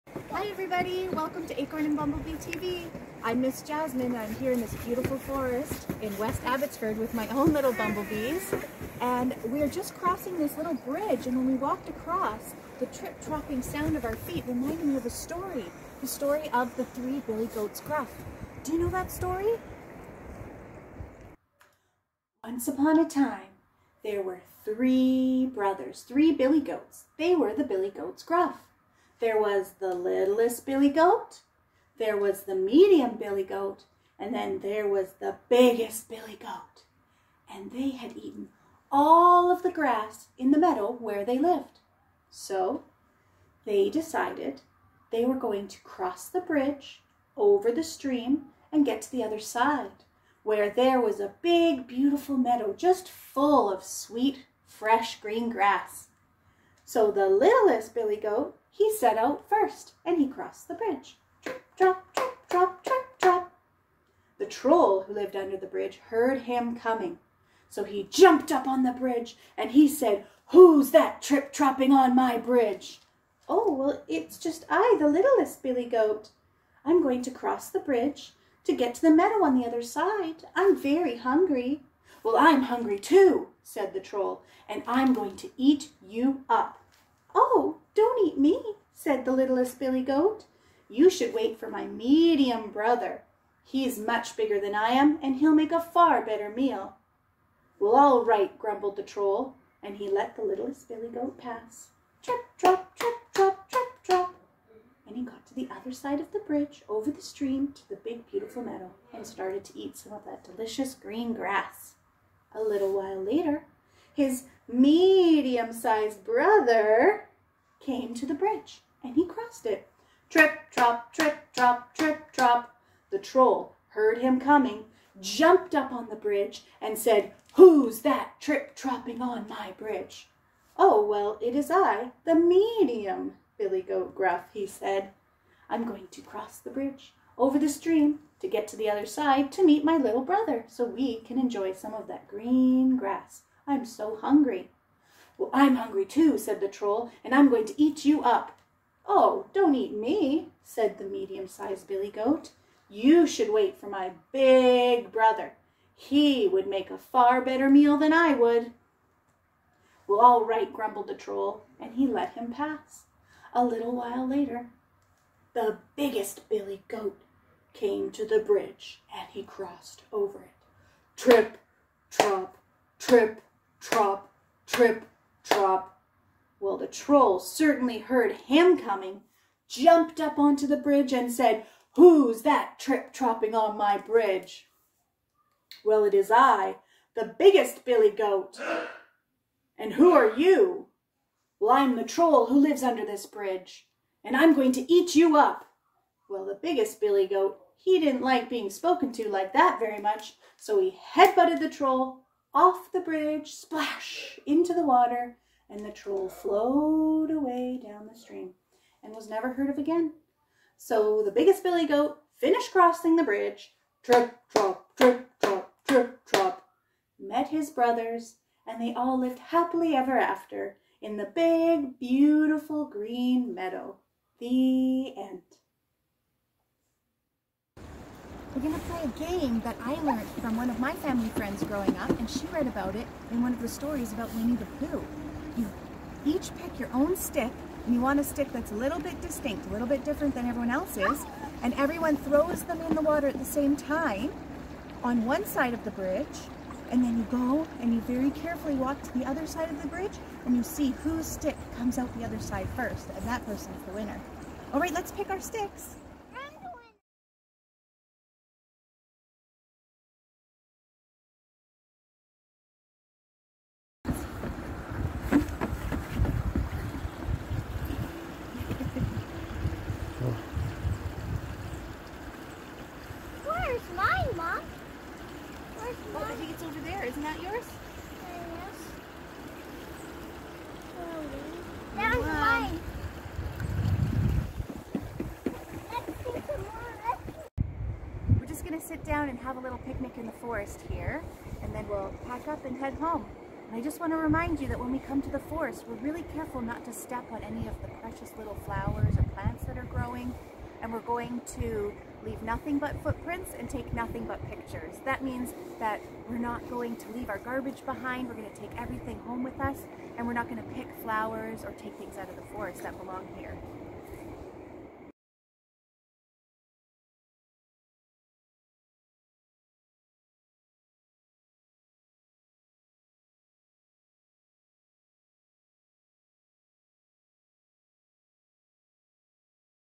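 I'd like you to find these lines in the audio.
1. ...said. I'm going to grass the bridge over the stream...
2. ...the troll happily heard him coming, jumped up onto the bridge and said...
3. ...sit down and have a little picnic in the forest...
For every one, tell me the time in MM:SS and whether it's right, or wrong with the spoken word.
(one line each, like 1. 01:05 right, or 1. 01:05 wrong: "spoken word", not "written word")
1. 02:14 wrong: "cross", not "grass"
2. 02:56 wrong: "certainly", not "happily"
3. 04:48 right.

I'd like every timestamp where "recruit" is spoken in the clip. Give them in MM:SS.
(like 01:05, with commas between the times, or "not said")
not said.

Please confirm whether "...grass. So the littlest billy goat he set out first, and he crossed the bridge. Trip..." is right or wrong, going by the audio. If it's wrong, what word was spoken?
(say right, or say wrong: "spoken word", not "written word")
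right.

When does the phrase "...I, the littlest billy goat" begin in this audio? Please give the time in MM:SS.
01:14.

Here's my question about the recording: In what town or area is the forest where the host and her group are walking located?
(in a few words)
West Abbotsford.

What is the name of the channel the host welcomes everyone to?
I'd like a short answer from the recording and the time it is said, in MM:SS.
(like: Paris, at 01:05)
Acorn and Bumblebee TV, at 00:01.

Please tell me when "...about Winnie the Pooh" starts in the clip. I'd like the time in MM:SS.
03:54.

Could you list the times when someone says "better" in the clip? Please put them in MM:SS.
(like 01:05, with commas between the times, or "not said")
01:36, 02:37.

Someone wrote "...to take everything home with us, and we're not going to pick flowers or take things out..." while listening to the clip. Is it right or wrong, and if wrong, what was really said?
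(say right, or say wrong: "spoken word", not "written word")
right.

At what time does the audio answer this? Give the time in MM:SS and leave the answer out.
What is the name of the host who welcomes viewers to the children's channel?
00:03.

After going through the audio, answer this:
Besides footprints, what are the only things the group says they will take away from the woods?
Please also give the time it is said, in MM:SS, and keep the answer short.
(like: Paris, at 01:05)
pictures, at 05:04.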